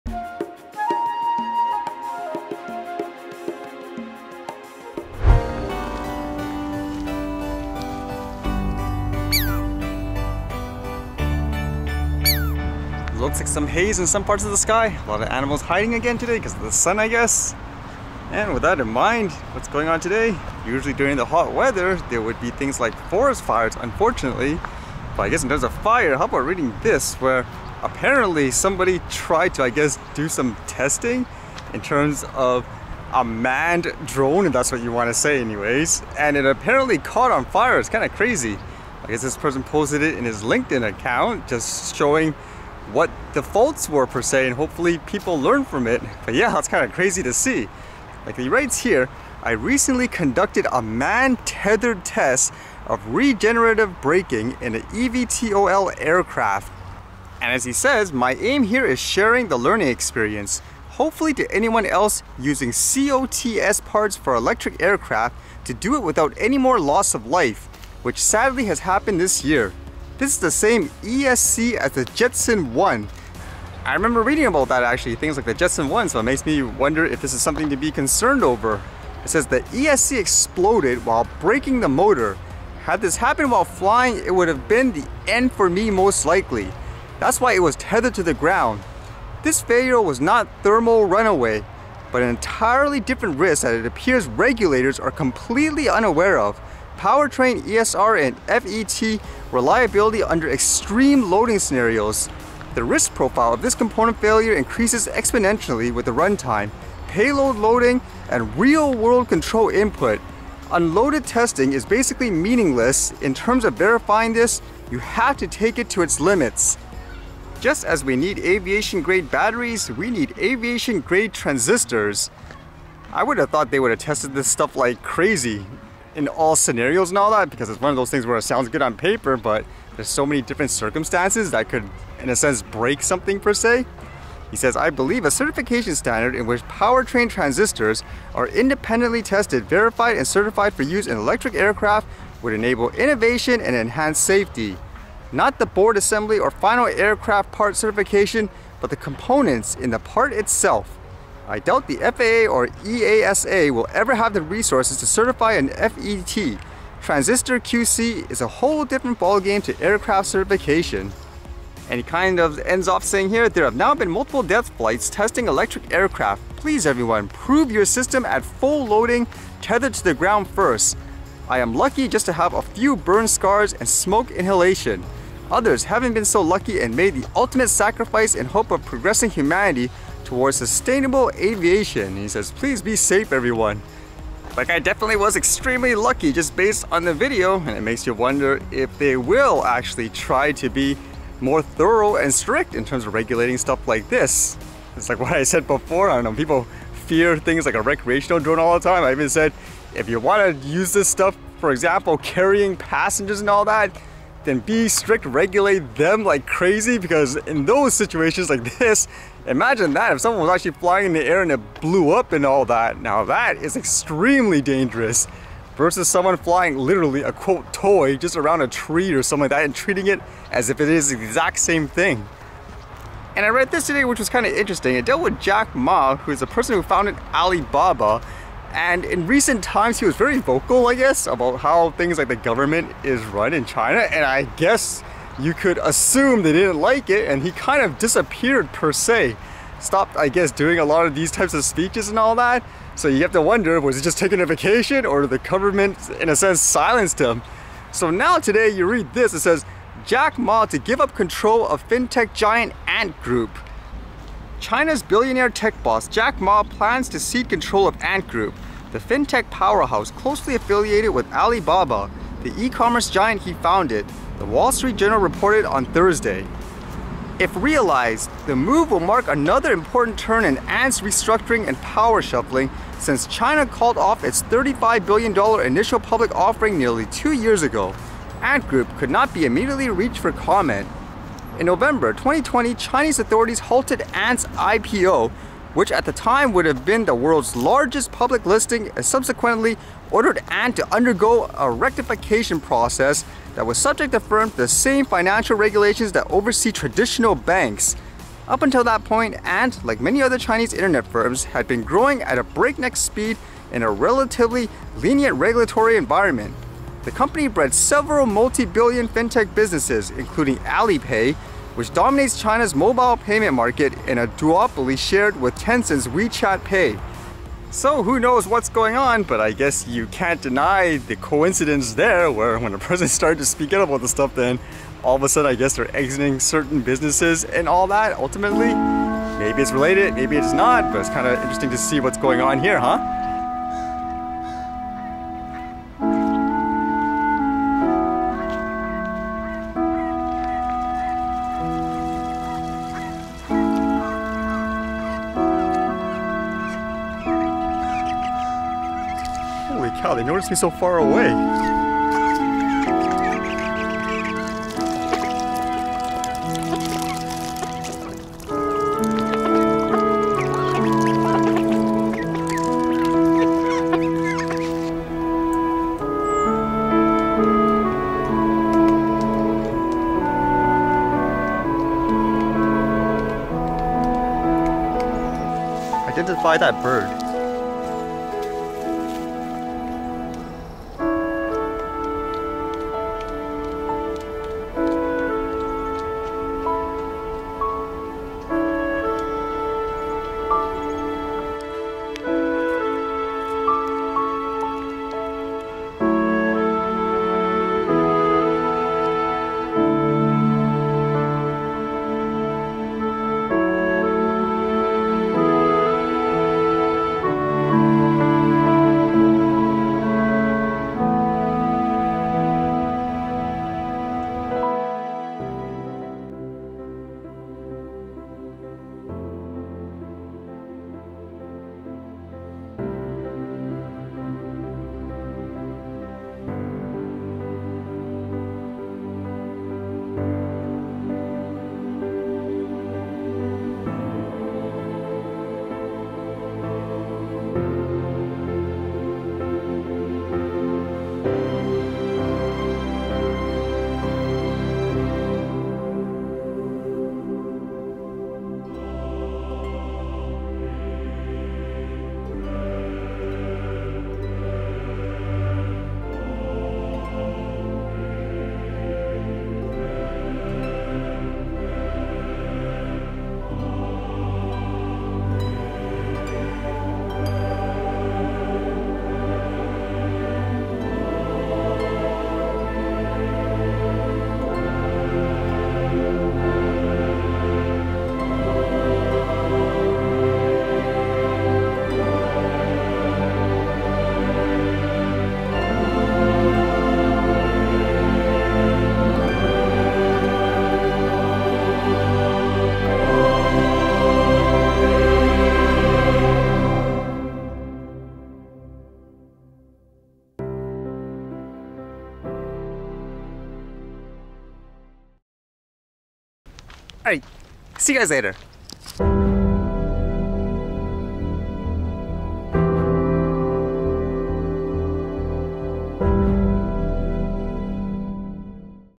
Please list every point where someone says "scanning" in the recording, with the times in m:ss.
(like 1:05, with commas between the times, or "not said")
not said.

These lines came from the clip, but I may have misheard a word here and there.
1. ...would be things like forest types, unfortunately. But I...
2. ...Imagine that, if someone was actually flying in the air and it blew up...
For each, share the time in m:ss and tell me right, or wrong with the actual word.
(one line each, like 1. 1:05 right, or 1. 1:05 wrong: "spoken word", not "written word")
1. 0:22 wrong: "fires", not "types"
2. 3:29 right.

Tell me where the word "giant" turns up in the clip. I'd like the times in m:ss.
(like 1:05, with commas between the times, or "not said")
4:12, 4:23.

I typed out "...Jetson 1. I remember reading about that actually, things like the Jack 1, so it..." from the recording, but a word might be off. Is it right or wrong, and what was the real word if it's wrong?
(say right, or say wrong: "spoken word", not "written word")
wrong: "Jetson", not "Jack".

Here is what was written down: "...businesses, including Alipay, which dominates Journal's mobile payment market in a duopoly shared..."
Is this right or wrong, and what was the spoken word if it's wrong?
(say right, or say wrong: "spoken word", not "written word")
wrong: "China", not "Journal".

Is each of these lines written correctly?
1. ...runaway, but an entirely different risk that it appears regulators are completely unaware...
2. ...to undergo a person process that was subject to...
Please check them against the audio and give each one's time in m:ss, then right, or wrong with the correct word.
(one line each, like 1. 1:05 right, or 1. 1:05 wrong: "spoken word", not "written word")
1. 1:31 right
2. 4:50 wrong: "rectification", not "person".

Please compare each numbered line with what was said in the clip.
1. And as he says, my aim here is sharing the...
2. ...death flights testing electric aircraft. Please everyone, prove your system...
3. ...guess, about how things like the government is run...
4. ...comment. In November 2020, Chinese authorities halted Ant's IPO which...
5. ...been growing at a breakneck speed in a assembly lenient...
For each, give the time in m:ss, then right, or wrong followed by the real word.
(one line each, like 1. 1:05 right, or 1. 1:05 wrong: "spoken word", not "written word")
1. 0:57 right
2. 2:44 right
3. 3:50 right
4. 4:40 right
5. 5:01 wrong: "relatively", not "assembly".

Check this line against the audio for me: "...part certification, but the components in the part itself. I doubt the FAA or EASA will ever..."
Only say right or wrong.
right.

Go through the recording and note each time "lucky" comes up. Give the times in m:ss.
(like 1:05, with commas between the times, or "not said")
2:51, 2:56, 3:05.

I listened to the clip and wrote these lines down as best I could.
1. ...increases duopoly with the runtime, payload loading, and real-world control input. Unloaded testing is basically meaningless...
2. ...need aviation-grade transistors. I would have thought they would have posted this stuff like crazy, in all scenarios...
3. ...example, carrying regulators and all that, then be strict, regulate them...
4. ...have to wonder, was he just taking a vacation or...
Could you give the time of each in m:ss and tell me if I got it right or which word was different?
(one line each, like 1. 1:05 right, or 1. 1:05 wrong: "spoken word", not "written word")
1. 1:44 wrong: "exponentially", not "duopoly"
2. 2:00 wrong: "tested", not "posted"
3. 3:21 wrong: "passengers", not "regulators"
4. 4:03 right.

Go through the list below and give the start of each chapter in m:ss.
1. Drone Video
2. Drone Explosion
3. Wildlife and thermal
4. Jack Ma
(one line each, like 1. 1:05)
1. 6:55
2. 0:18
3. 5:33
4. 3:42.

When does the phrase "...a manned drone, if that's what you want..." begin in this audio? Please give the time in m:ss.
0:33.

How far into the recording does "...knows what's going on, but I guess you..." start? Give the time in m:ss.
5:18.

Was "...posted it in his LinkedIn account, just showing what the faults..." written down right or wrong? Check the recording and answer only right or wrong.
right.